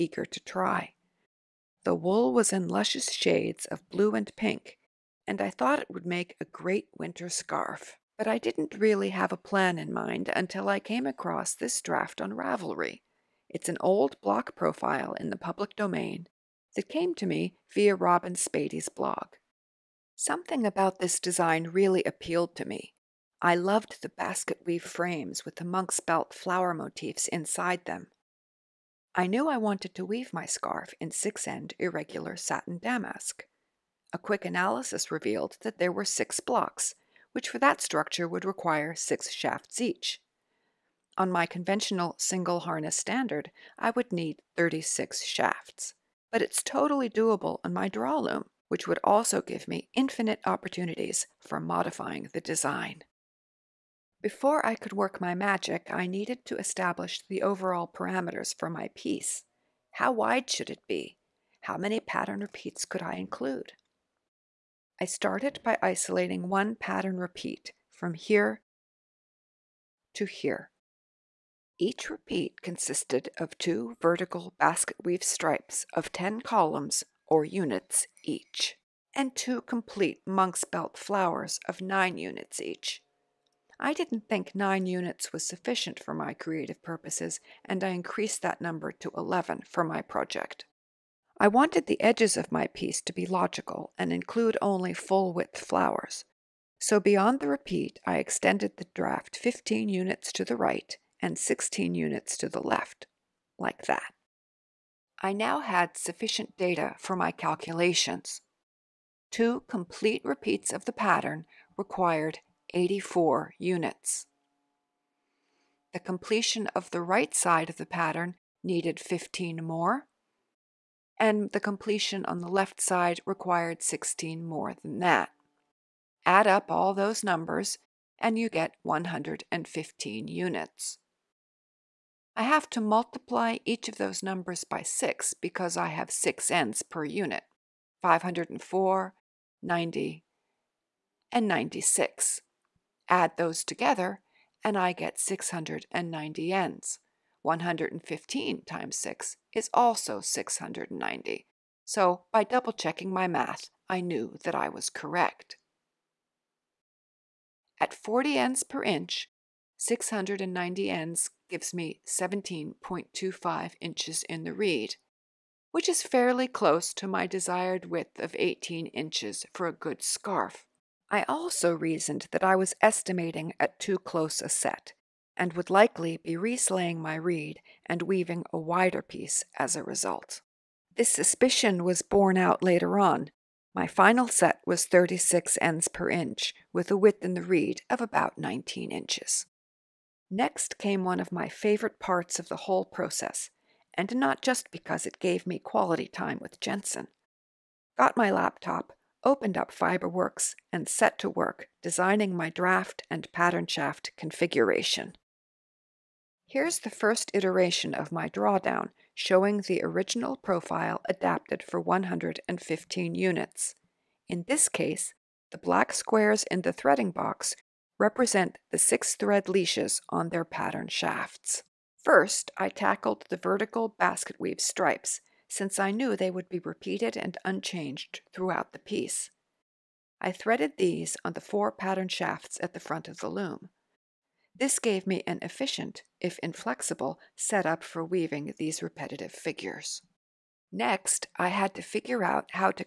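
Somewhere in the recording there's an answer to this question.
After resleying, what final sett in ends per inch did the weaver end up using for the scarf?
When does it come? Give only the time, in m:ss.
3:04.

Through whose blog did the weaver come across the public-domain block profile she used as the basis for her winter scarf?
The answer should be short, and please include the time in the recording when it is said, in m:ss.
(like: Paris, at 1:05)
Robyn Spady, at 0:17.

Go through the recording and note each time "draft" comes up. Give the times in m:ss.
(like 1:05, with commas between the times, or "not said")
0:11, 1:38, 3:22.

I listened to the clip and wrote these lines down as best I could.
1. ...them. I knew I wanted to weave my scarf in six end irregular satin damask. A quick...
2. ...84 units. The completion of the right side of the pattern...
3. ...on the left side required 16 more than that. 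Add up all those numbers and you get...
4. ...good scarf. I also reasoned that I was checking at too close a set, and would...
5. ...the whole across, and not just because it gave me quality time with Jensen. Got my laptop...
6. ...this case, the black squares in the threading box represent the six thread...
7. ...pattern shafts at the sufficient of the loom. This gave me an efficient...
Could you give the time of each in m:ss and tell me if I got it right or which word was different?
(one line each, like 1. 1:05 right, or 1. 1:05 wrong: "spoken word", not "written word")
1. 0:27 right
2. 1:52 right
3. 2:02 right
4. 2:49 wrong: "estimating", not "checking"
5. 3:12 wrong: "process", not "across"
6. 3:34 right
7. 3:51 wrong: "front", not "sufficient".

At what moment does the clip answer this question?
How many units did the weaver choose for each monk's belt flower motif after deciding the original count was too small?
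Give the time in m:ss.
1:29.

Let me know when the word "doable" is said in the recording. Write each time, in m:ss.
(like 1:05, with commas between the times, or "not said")
0:47.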